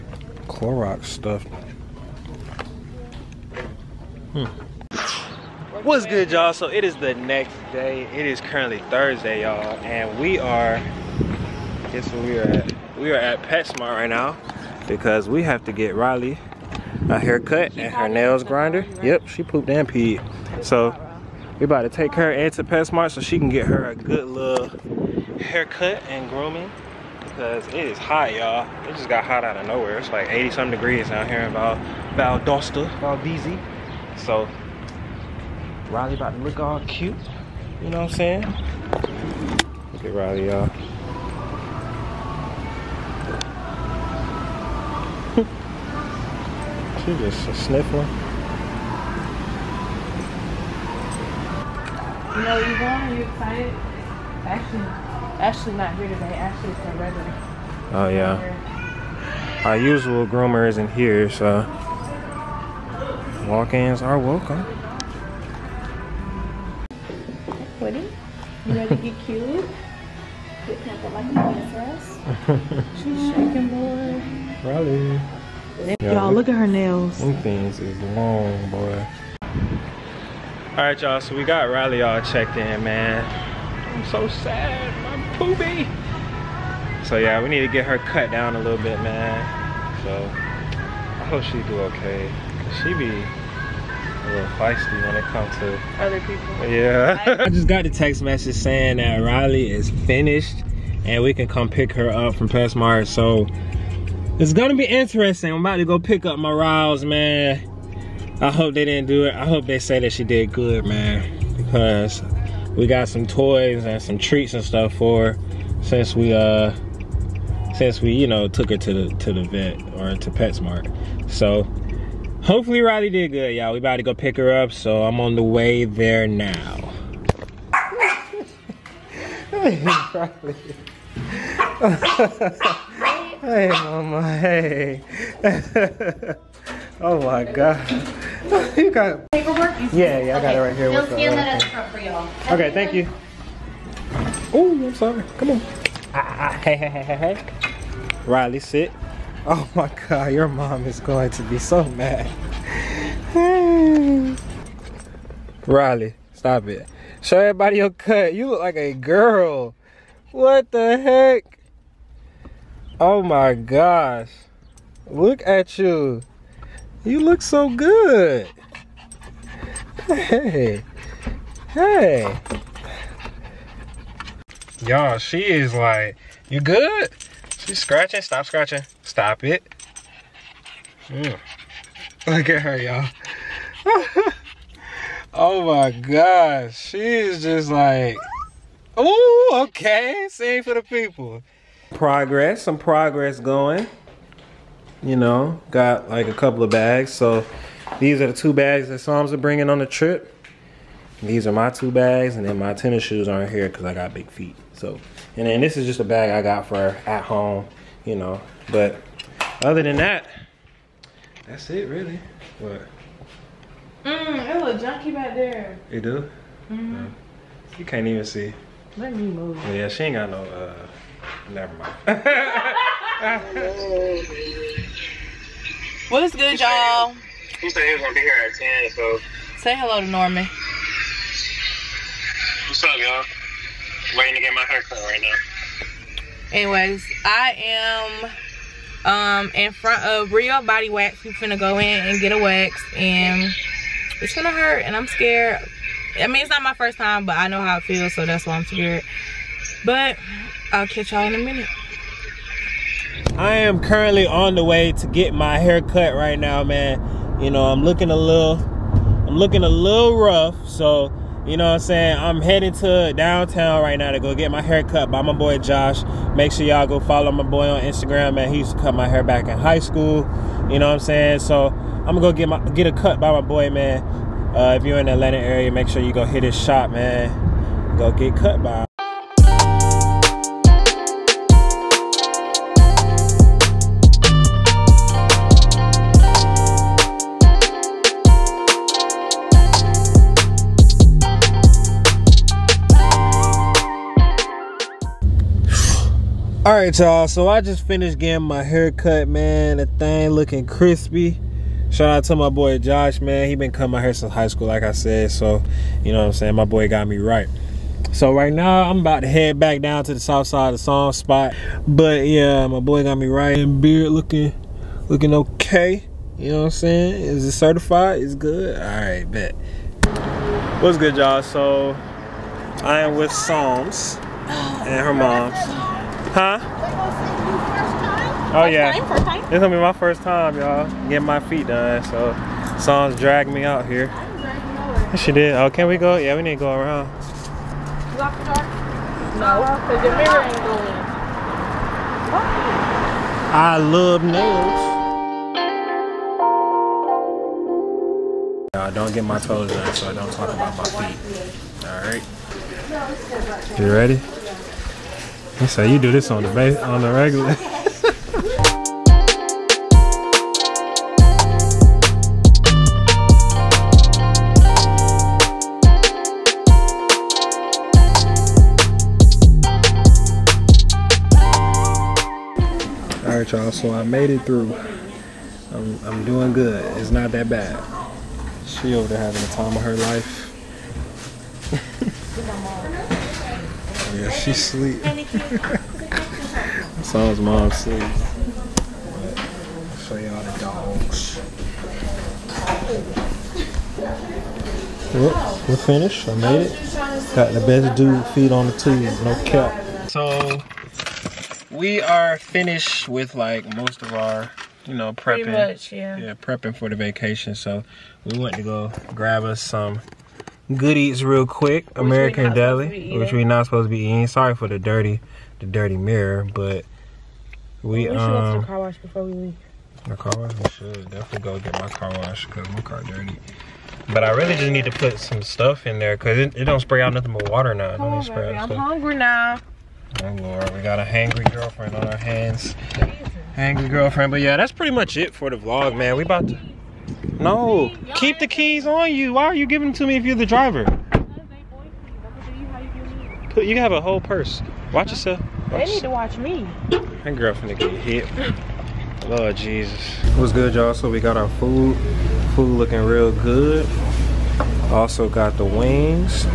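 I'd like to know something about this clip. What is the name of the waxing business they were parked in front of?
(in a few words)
Real Body Wax.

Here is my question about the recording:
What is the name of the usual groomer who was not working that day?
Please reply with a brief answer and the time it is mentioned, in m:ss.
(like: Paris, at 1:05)
Ashley, at 0:55.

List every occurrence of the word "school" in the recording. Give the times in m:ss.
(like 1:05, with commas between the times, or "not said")
4:29, 5:04.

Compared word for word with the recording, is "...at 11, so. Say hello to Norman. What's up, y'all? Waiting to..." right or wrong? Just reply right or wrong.
wrong.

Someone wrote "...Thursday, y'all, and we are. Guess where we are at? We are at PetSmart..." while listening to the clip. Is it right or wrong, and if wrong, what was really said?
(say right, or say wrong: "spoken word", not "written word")
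right.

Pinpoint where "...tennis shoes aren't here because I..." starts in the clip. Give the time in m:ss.
3:22.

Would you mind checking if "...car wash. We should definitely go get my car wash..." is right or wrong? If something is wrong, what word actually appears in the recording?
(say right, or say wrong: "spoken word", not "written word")
right.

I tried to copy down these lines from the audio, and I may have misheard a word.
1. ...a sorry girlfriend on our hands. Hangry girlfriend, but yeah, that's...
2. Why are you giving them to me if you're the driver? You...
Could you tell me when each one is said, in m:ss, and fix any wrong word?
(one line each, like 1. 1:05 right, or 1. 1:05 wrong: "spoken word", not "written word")
1. 7:11 wrong: "hangry", not "sorry"
2. 7:19 right.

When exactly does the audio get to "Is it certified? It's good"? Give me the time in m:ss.
5:17.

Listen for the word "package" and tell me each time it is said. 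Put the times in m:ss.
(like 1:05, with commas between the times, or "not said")
not said.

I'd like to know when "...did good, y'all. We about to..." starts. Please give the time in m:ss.
2:03.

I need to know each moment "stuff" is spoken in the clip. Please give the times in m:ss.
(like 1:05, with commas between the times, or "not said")
0:01, 1:54, 7:05.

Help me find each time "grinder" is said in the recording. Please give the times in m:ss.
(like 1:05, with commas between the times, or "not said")
0:18.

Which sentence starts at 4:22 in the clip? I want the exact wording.
I'm heading to downtown right now to go get my hair cut by my boy Josh.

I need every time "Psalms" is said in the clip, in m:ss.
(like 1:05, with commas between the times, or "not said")
3:18, 5:10, 5:23, 5:32.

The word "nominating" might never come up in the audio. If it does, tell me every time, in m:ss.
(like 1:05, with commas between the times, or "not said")
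not said.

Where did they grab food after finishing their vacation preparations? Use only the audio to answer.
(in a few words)
American Deli.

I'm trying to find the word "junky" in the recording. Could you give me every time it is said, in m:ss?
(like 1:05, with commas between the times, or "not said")
3:34.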